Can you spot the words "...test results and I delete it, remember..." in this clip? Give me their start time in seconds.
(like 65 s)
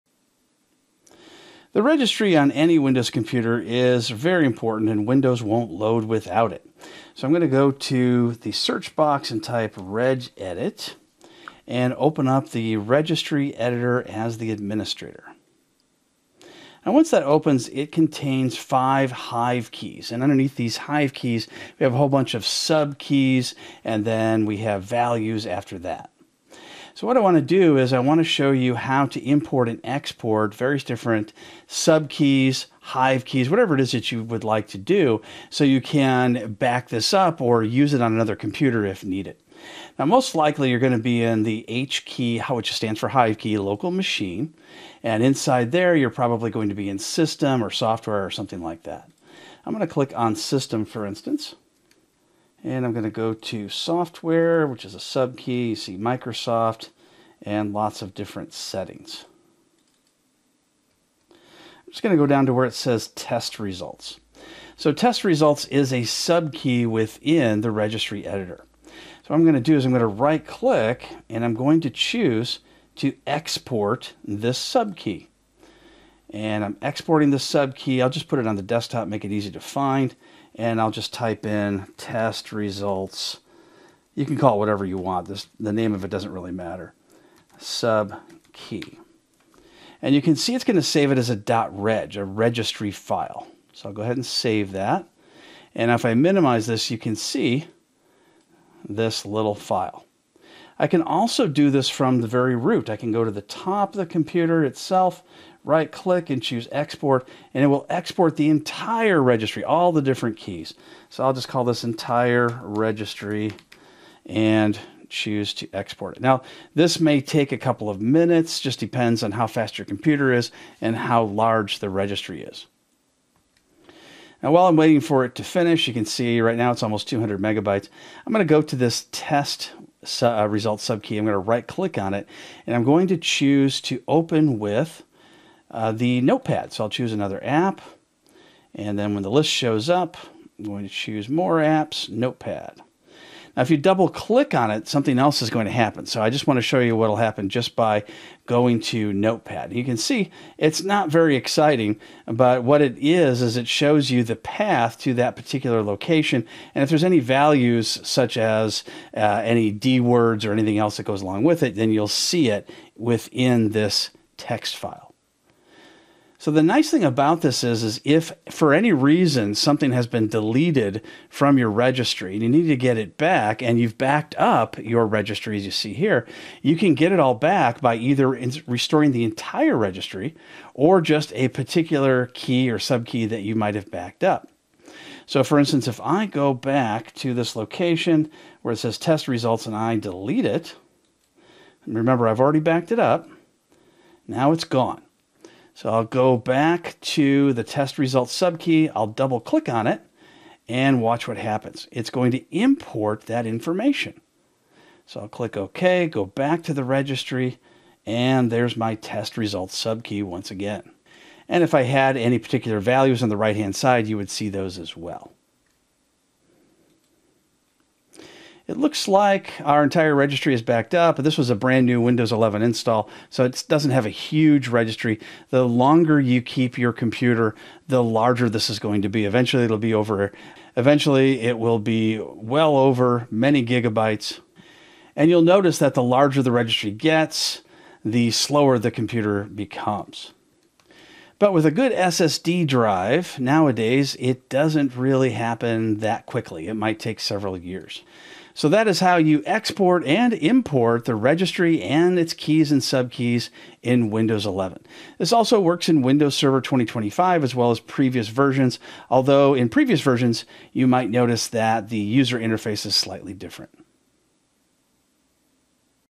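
188 s.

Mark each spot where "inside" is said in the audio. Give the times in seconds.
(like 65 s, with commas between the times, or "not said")
45 s.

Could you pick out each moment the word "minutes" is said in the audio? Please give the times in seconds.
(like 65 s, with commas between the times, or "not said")
118 s.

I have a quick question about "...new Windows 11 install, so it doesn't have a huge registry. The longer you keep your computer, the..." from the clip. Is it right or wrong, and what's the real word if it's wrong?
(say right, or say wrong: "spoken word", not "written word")
right.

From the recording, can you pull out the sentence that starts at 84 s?
You can call it whatever you want.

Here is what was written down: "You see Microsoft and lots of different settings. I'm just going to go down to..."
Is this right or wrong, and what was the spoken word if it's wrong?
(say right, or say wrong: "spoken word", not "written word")
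right.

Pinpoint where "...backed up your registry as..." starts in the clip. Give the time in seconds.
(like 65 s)
173 s.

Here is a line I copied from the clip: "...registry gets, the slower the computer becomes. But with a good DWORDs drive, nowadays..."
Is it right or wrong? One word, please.
wrong.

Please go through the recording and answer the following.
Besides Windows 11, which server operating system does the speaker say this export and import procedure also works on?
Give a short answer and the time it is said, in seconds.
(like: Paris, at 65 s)
Windows Server 2025, at 256 s.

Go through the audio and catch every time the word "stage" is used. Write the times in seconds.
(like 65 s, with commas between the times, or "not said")
not said.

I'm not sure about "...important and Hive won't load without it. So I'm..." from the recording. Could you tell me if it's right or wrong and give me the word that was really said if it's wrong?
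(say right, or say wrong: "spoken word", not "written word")
wrong: "Windows", not "Hive".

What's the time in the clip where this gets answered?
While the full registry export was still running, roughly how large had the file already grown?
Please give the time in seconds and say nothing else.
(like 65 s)
126 s.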